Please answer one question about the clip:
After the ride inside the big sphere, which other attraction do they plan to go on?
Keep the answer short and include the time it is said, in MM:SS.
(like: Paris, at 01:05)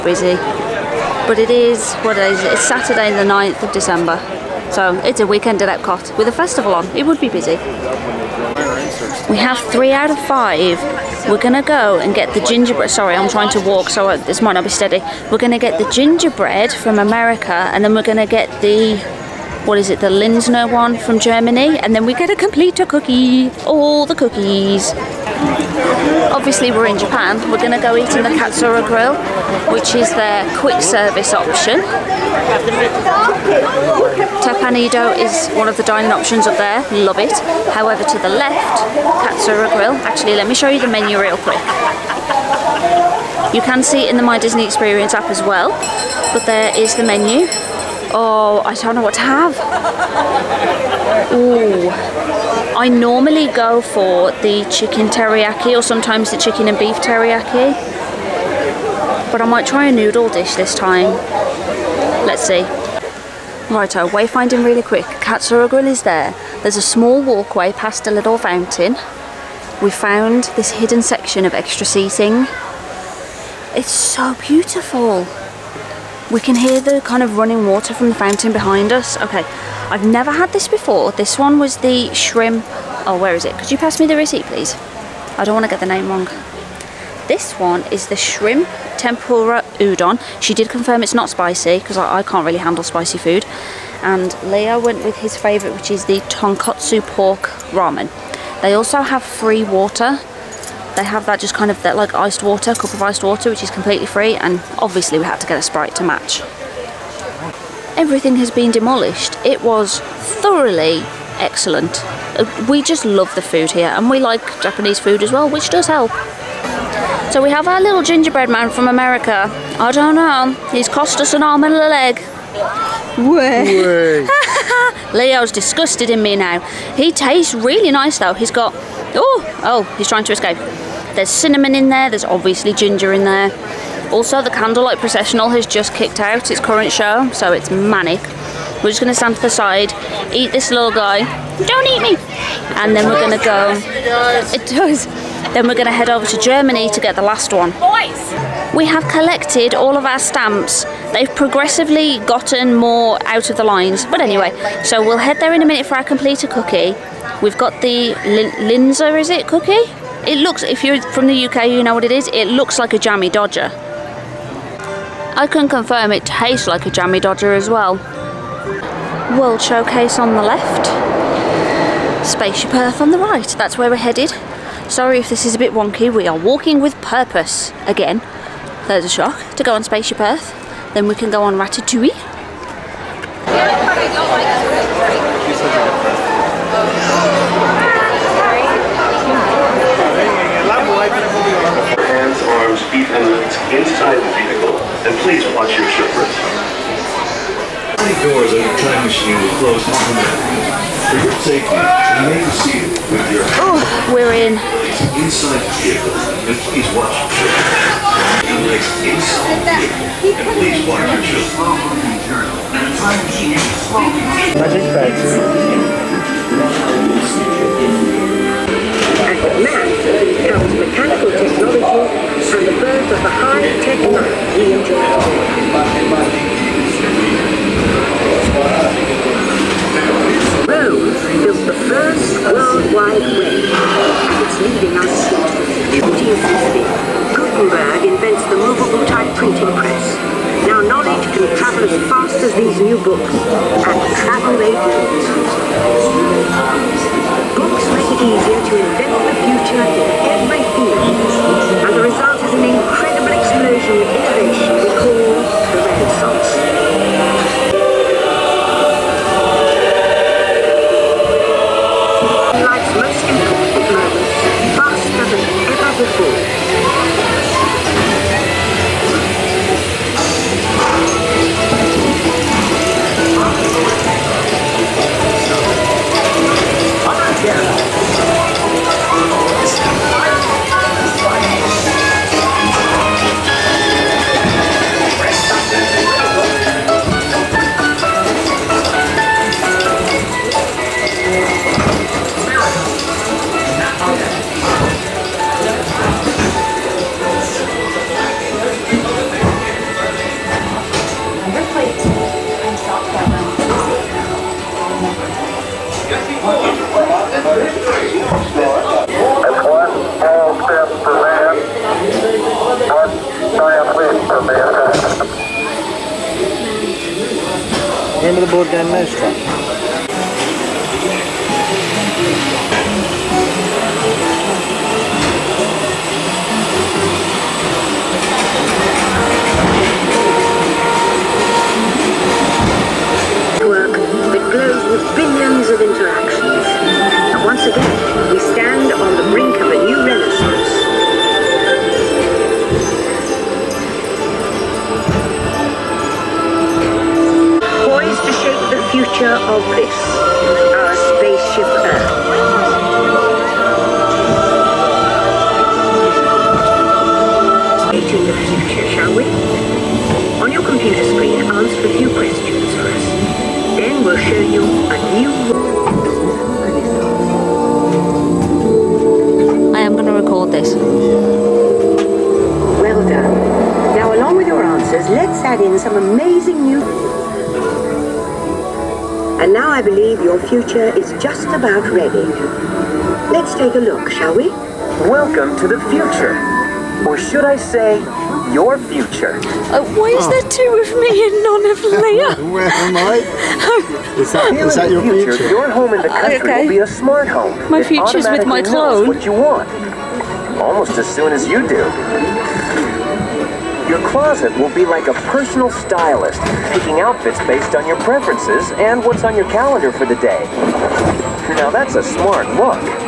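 Ratatouille, at 03:01.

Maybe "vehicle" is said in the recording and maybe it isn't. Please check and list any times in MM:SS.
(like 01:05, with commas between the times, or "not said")
03:14, 03:25, 03:29.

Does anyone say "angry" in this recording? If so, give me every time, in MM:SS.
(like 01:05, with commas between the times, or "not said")
not said.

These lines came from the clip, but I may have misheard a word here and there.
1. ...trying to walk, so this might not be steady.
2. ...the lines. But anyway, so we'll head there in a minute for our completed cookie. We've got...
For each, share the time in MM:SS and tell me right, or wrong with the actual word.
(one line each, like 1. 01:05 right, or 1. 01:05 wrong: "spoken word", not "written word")
1. 00:13 right
2. 02:33 right.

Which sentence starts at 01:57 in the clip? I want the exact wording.
So we have our little gingerbread man from America.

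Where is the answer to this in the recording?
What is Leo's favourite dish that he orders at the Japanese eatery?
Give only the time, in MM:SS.
01:36.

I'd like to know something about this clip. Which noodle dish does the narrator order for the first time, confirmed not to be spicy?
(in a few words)
Shrimp tempura udon.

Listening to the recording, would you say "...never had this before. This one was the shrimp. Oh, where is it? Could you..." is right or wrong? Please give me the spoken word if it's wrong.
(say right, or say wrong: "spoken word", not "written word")
right.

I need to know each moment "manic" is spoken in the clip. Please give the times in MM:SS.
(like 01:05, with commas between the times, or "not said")
02:17.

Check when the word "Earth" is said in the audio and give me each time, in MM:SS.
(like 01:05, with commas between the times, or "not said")
02:52, 03:00.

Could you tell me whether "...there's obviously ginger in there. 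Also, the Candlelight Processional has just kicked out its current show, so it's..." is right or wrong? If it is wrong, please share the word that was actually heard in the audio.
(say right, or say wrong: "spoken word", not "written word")
right.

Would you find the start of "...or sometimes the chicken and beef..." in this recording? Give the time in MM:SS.
00:55.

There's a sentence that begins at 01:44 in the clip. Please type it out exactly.
And obviously we had to get a Sprite to match.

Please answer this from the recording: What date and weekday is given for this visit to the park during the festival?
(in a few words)
Saturday 9th December.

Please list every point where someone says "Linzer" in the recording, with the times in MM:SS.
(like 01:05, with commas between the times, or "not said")
00:20, 02:38.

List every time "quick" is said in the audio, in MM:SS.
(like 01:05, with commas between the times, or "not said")
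00:30, 00:41, 01:04.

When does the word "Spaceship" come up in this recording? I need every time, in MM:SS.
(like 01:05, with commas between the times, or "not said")
02:52, 02:59.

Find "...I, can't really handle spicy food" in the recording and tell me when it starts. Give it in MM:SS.
01:32.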